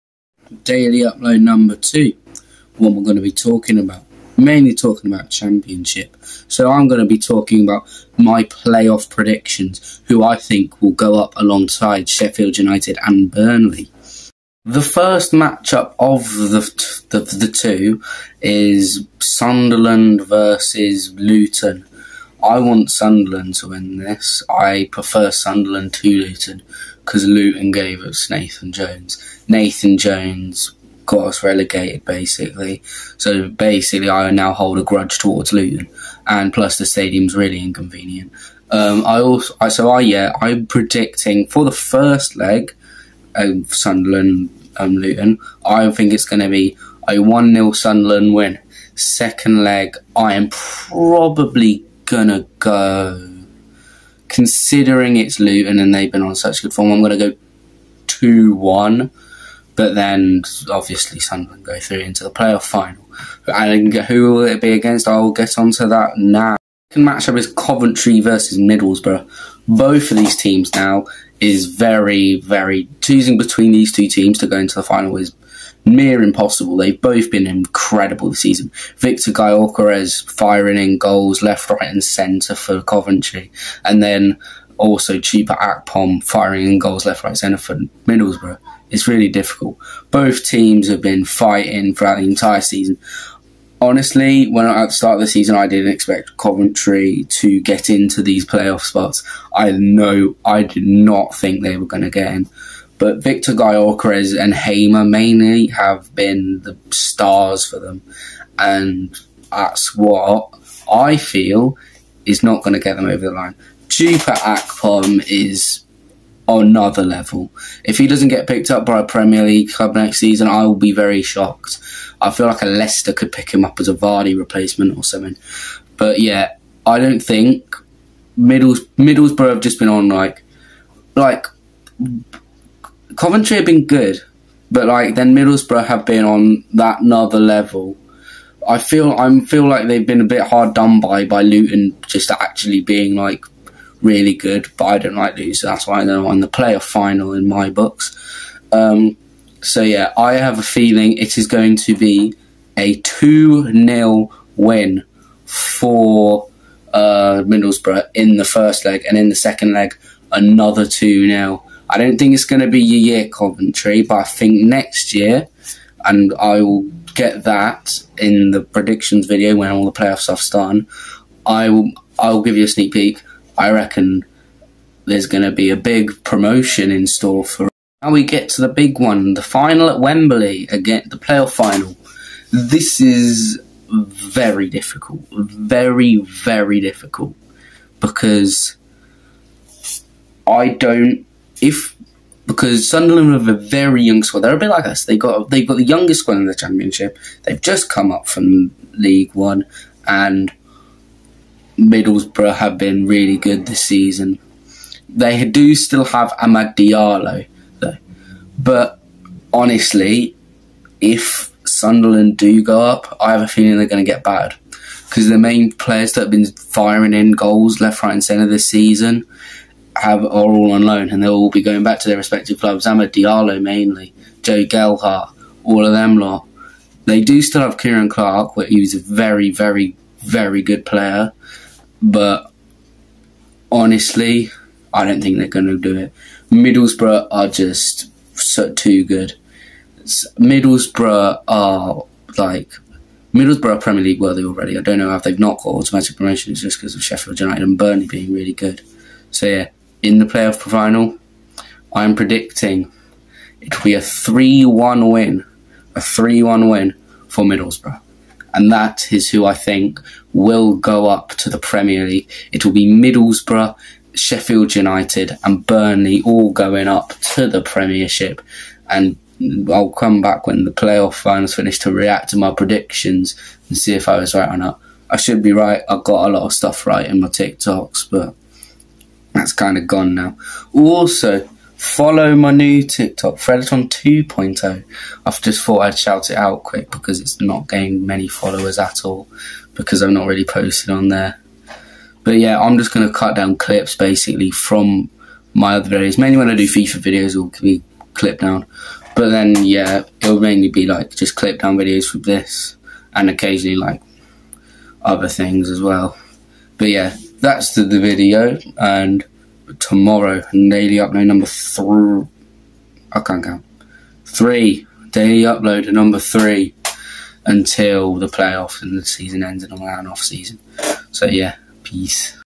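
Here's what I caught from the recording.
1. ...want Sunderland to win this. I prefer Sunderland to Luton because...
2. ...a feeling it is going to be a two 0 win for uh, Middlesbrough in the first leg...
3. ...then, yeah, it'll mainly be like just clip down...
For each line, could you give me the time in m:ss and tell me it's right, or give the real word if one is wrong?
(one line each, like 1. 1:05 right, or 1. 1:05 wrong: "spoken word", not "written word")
1. 0:22 right
2. 2:30 right
3. 4:59 right.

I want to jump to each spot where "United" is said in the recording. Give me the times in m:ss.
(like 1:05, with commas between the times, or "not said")
0:12, 4:07, 4:24.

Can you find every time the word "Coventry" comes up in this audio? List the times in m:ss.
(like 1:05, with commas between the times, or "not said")
1:07, 1:22, 1:36, 2:13, 2:43.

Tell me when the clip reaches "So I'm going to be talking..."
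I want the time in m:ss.
0:06.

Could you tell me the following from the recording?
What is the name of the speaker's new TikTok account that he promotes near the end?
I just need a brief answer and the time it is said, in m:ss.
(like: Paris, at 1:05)
Fredatron 2.0, at 4:43.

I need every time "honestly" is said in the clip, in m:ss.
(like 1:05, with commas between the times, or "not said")
1:33, 3:29, 3:53.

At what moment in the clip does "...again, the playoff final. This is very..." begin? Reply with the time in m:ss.
3:00.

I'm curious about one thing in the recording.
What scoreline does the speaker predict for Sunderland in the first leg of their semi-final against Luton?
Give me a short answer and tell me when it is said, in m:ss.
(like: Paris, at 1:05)
1-0, at 0:47.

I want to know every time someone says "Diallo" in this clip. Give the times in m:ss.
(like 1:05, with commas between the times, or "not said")
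3:26, 3:43.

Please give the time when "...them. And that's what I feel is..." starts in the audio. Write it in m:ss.
1:47.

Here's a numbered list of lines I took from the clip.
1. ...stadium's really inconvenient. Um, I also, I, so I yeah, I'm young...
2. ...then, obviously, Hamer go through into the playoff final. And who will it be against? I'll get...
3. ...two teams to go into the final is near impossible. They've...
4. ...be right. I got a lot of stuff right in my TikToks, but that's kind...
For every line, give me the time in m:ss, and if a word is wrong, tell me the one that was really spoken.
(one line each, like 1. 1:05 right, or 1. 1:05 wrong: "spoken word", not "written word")
1. 0:36 wrong: "predicting", not "young"
2. 0:59 wrong: "Sunderland", not "Hamer"
3. 1:13 right
4. 4:35 right.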